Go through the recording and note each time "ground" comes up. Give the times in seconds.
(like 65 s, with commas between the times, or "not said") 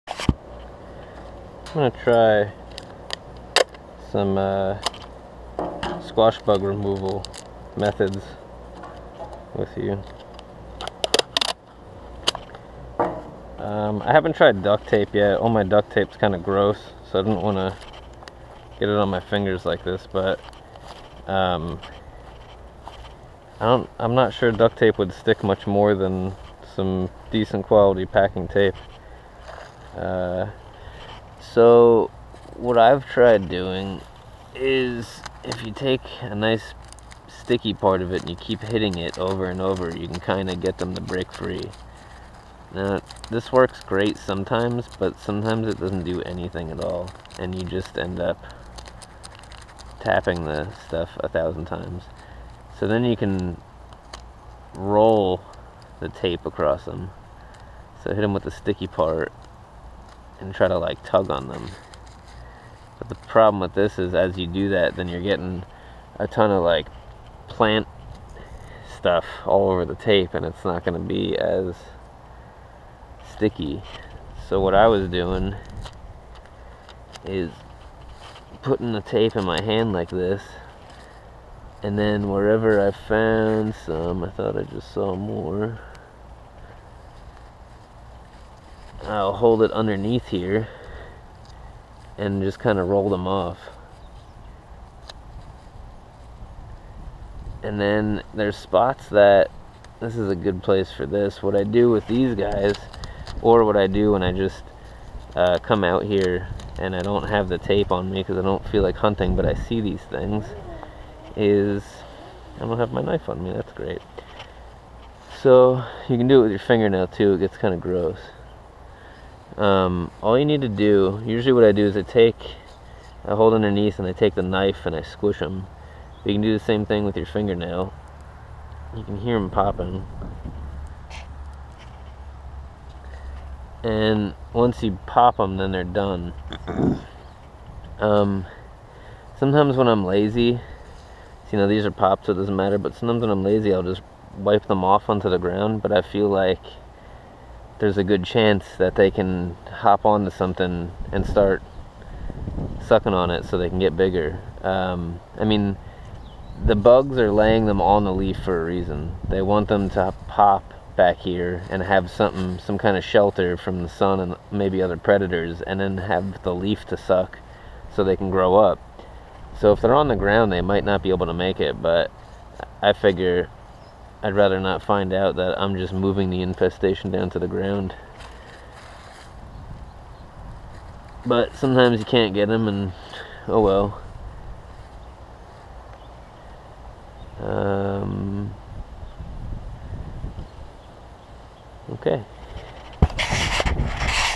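145 s, 170 s, 177 s.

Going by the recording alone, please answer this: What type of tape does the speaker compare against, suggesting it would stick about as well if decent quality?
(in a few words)
packing tape.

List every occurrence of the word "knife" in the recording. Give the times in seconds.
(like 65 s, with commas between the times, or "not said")
113 s, 124 s.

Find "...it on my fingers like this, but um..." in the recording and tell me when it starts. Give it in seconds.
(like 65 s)
18 s.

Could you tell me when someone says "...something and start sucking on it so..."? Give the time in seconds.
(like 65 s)
150 s.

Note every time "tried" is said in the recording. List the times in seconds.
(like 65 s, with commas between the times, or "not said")
14 s, 33 s.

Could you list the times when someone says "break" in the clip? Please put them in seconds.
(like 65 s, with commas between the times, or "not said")
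41 s.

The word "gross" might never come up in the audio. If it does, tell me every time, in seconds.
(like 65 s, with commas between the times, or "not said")
16 s, 117 s.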